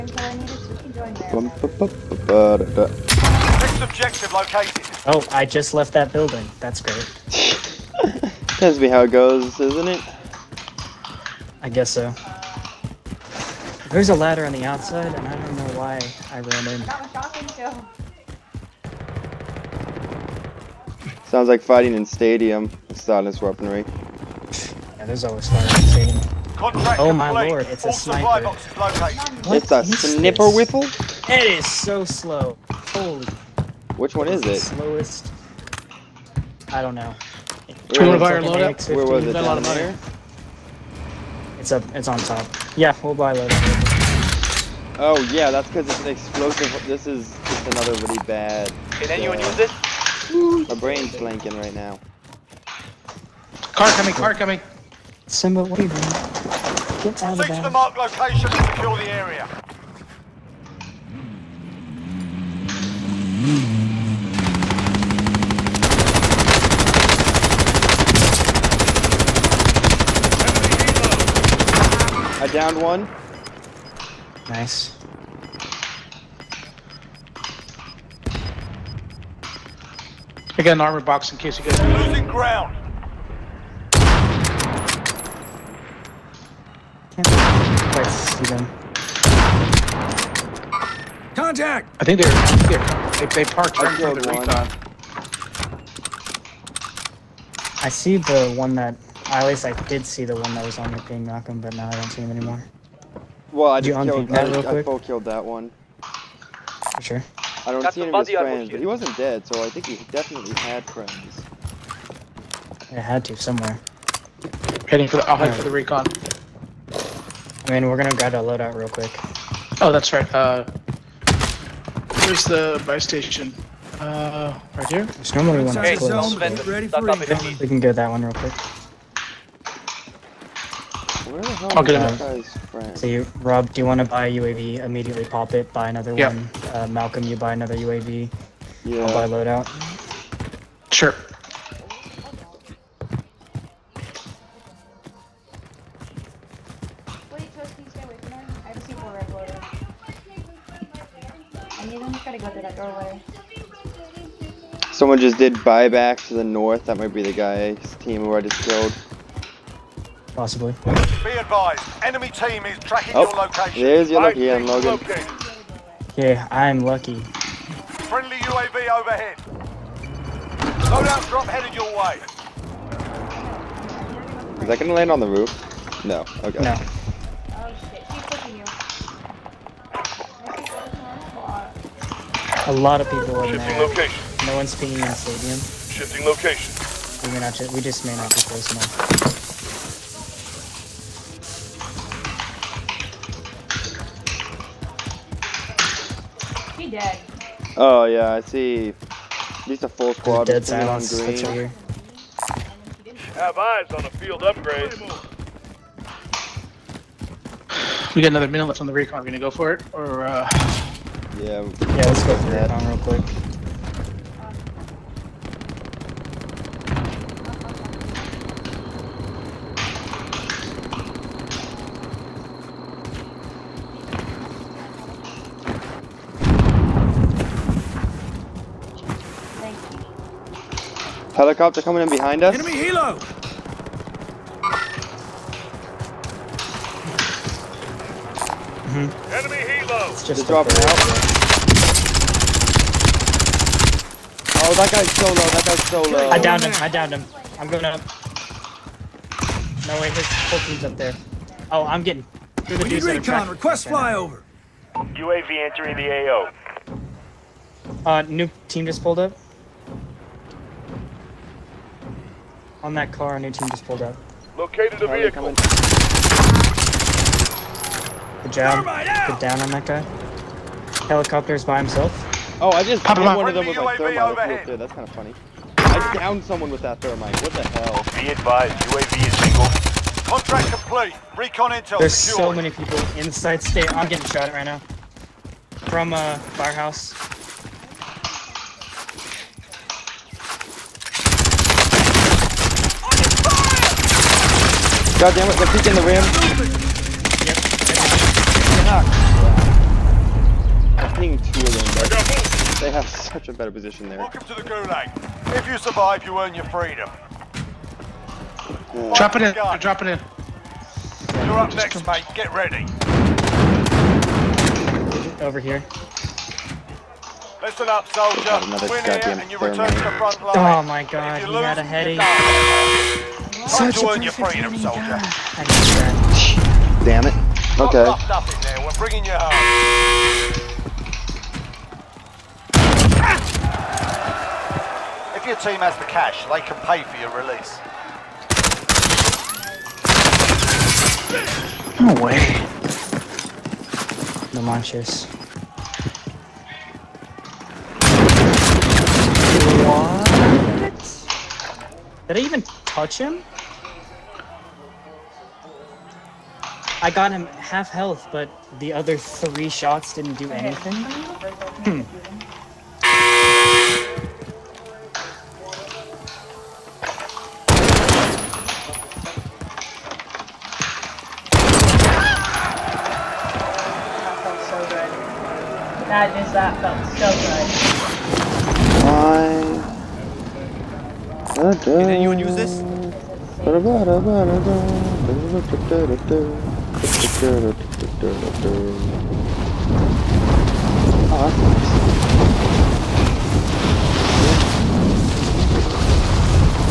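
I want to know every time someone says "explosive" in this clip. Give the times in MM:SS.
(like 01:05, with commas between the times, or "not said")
00:46.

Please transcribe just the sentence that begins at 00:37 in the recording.
We're gonna buy our load up.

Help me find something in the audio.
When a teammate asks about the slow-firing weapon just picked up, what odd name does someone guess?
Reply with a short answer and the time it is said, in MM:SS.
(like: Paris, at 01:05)
Whiffle, at 00:30.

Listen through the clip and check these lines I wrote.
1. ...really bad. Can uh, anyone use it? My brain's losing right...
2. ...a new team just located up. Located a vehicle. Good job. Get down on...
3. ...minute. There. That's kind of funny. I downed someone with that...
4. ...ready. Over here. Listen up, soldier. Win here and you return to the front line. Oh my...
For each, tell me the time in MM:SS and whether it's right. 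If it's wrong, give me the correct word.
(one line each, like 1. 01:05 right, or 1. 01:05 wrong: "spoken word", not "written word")
1. 00:48 wrong: "blanking", not "losing"
2. 04:23 wrong: "pulled", not "located"
3. 04:33 wrong: "thermite", not "minute"
4. 05:12 right.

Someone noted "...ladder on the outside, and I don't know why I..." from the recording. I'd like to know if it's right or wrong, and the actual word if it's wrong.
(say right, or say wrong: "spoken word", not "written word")
right.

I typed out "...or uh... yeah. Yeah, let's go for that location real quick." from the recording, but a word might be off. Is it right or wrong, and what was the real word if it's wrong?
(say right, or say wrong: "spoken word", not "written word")
wrong: "recon", not "location".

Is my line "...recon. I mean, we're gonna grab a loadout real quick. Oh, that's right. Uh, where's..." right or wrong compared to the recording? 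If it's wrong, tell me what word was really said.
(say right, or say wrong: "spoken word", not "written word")
right.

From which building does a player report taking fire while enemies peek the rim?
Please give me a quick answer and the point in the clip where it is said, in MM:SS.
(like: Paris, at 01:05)
Firehouse, at 04:46.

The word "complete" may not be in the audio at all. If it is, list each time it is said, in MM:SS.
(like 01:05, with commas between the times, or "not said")
00:27, 04:40.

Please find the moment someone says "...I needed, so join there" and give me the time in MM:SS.
00:00.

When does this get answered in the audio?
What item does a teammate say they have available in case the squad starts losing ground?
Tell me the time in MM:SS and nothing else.
01:20.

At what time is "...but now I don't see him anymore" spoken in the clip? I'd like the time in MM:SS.
01:41.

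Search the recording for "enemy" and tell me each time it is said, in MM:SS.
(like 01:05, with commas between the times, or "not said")
02:42, 03:52, 03:59.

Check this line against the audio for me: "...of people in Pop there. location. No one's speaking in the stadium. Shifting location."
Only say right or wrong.
wrong.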